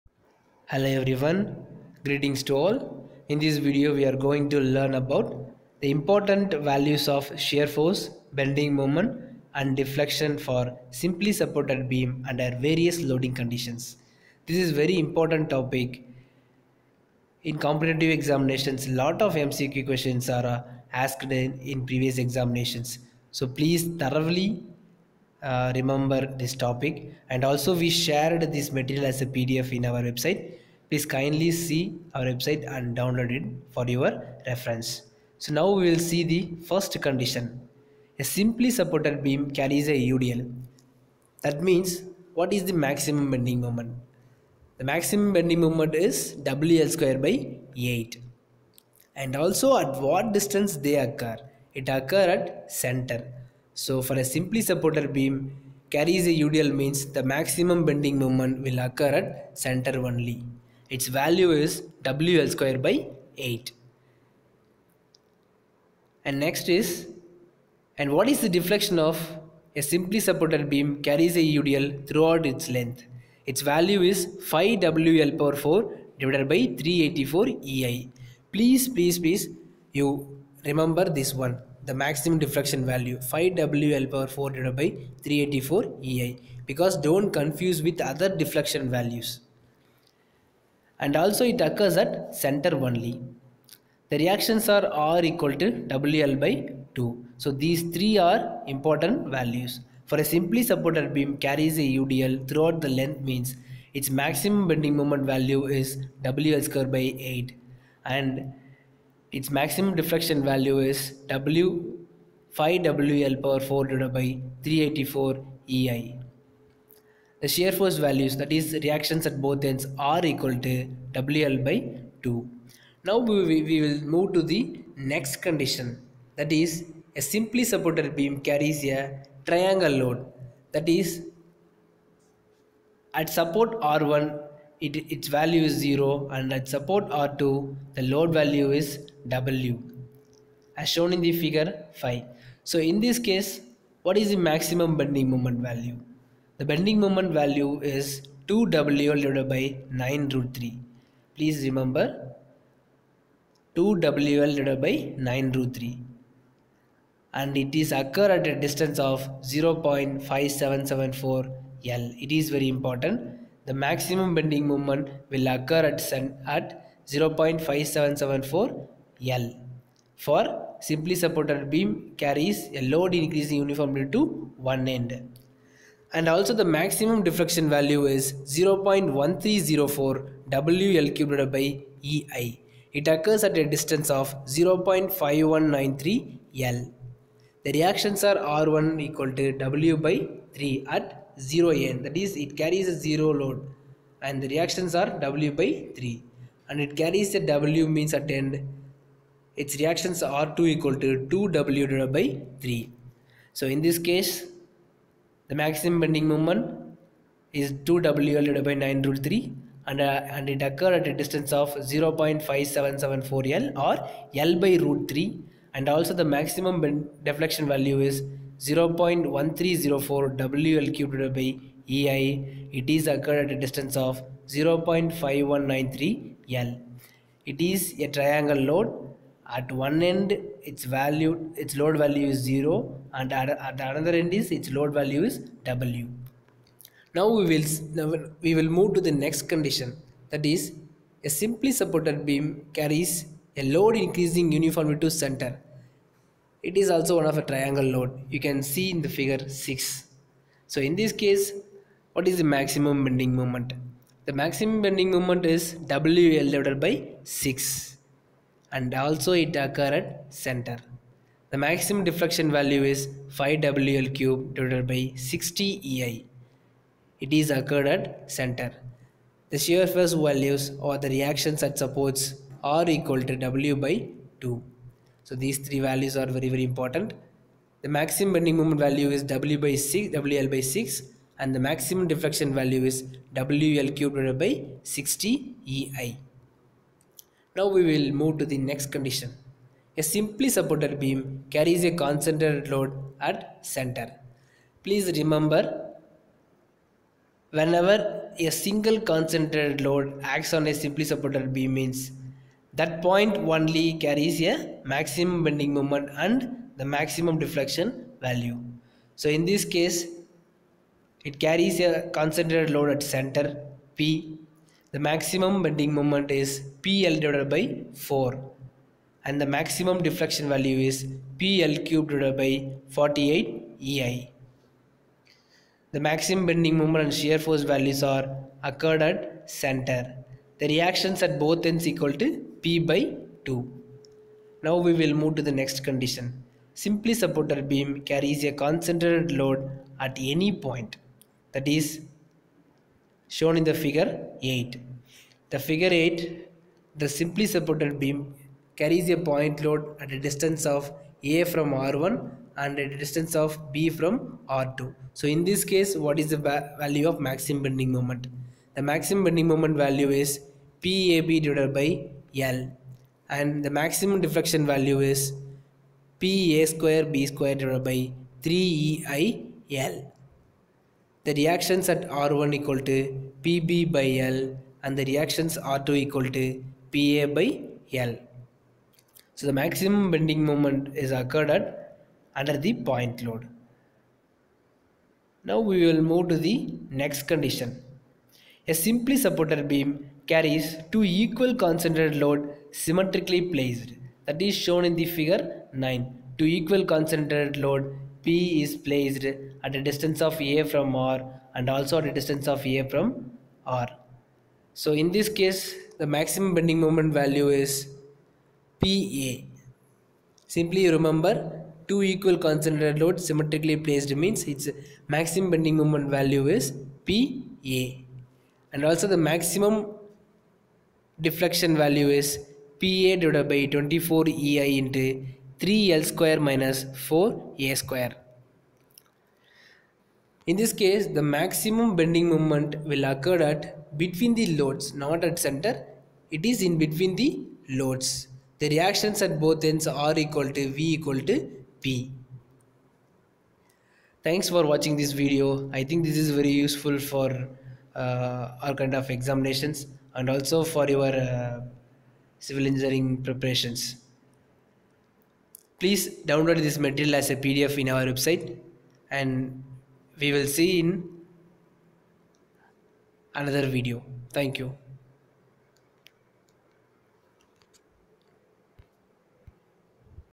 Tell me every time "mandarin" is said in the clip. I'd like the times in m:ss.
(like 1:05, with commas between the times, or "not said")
not said.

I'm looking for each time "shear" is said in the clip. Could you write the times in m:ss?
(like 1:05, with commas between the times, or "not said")
0:07, 1:57, 4:29, 5:27.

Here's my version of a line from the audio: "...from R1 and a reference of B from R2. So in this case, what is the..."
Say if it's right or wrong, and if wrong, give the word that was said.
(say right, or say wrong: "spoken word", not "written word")
wrong: "distance", not "reference".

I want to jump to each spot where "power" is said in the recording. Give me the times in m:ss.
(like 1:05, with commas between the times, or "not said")
1:15, 1:24, 1:53.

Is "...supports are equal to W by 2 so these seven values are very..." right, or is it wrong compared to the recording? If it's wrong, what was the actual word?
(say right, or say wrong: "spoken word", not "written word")
wrong: "three", not "seven".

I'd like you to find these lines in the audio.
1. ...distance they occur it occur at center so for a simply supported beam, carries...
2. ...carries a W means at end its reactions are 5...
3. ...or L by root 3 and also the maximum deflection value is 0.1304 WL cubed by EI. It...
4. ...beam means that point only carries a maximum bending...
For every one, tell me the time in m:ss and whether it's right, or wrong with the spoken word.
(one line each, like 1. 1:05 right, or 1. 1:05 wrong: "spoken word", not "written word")
1. 0:50 right
2. 3:16 wrong: "2", not "5"
3. 3:33 right
4. 5:01 right.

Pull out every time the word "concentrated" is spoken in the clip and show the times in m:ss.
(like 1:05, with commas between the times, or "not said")
4:51, 4:58, 5:12, 5:38, 6:31, 6:36, 6:52.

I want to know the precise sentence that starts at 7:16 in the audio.
It is in between the loads.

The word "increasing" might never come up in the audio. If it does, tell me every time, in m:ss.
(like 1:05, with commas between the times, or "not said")
2:53, 4:03.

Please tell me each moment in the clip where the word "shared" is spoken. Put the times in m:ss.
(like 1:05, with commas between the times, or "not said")
0:27.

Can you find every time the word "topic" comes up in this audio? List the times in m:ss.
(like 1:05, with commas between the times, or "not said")
0:15, 0:26.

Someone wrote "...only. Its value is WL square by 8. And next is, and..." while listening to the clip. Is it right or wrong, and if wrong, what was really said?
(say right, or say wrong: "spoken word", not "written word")
right.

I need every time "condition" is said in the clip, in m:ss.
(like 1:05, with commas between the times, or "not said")
0:13, 0:37, 2:05, 3:59, 4:48, 5:35, 6:27.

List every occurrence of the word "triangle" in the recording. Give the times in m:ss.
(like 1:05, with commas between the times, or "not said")
2:09, 3:48, 4:07.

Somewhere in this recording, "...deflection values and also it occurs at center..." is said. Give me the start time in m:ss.
1:28.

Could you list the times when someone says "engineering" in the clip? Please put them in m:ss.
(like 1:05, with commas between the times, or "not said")
7:32.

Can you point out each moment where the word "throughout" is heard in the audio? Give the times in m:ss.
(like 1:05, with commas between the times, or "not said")
1:12, 1:42.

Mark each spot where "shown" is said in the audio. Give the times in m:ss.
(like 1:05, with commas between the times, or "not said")
2:20, 5:43, 6:34.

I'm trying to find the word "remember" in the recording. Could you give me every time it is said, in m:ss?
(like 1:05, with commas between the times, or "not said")
0:25, 1:20, 2:31, 4:55, 6:50.